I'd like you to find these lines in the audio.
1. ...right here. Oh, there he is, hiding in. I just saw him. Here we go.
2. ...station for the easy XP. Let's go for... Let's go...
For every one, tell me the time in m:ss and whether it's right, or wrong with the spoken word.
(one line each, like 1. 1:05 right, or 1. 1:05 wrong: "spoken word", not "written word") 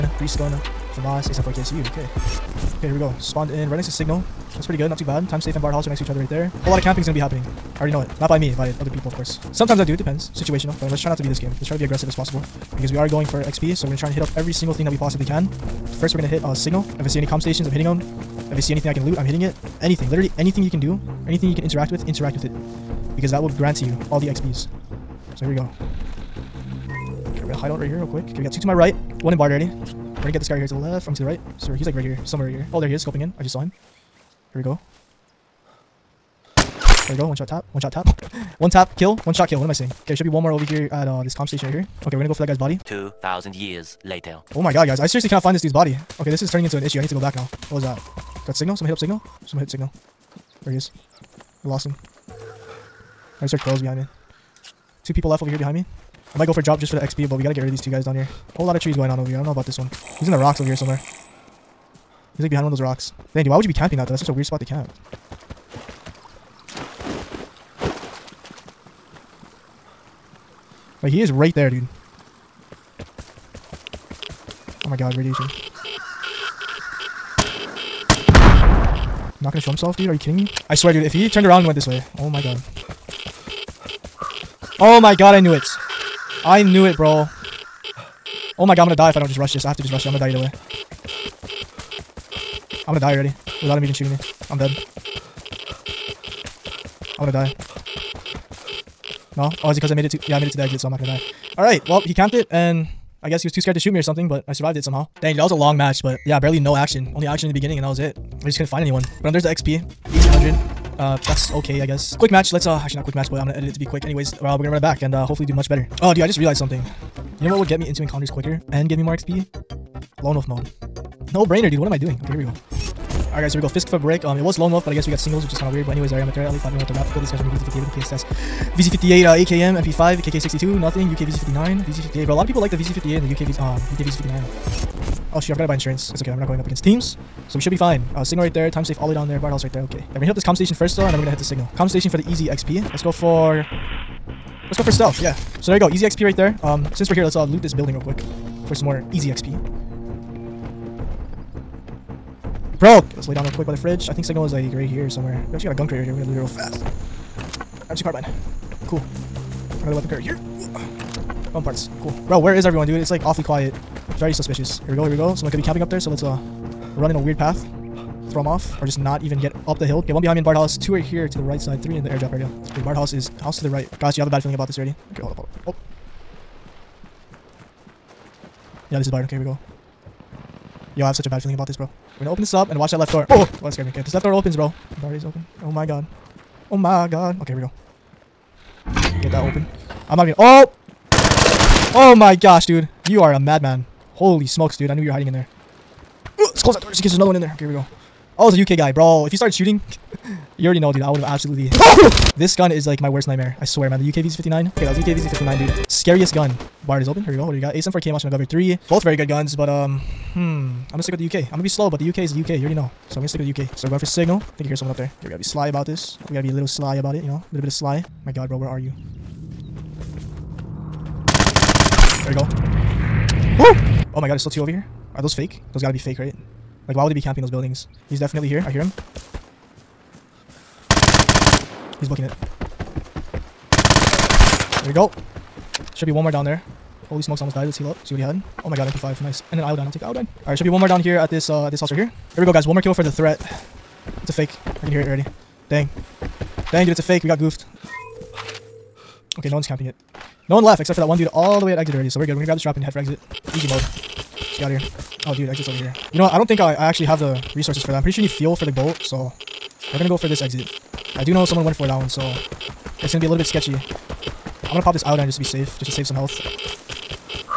1. 0:32 wrong: "scoping", not "hiding"
2. 2:21 right.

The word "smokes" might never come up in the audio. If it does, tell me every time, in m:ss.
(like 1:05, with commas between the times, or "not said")
3:14, 3:57.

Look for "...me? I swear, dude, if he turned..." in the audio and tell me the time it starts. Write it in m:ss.
1:20.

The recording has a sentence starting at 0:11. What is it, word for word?
Let's try to be aggressive as possible.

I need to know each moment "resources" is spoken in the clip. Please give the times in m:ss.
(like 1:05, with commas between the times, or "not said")
4:17.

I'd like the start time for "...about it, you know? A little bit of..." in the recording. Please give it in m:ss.
3:36.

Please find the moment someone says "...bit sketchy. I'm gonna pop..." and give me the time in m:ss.
4:23.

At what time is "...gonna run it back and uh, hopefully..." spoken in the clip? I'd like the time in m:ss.
1:54.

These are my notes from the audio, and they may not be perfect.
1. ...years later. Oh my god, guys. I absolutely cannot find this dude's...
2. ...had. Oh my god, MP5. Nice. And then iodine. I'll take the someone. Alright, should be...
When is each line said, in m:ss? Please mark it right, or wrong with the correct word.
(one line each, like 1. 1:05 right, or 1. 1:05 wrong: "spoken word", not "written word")
1. 0:43 wrong: "seriously", not "absolutely"
2. 3:58 wrong: "iodine", not "someone".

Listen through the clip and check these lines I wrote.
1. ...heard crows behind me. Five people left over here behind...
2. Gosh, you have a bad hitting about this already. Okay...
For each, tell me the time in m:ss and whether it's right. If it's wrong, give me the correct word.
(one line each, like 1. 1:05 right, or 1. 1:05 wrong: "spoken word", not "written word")
1. 0:53 wrong: "Two", not "Five"
2. 2:53 wrong: "feeling", not "hitting".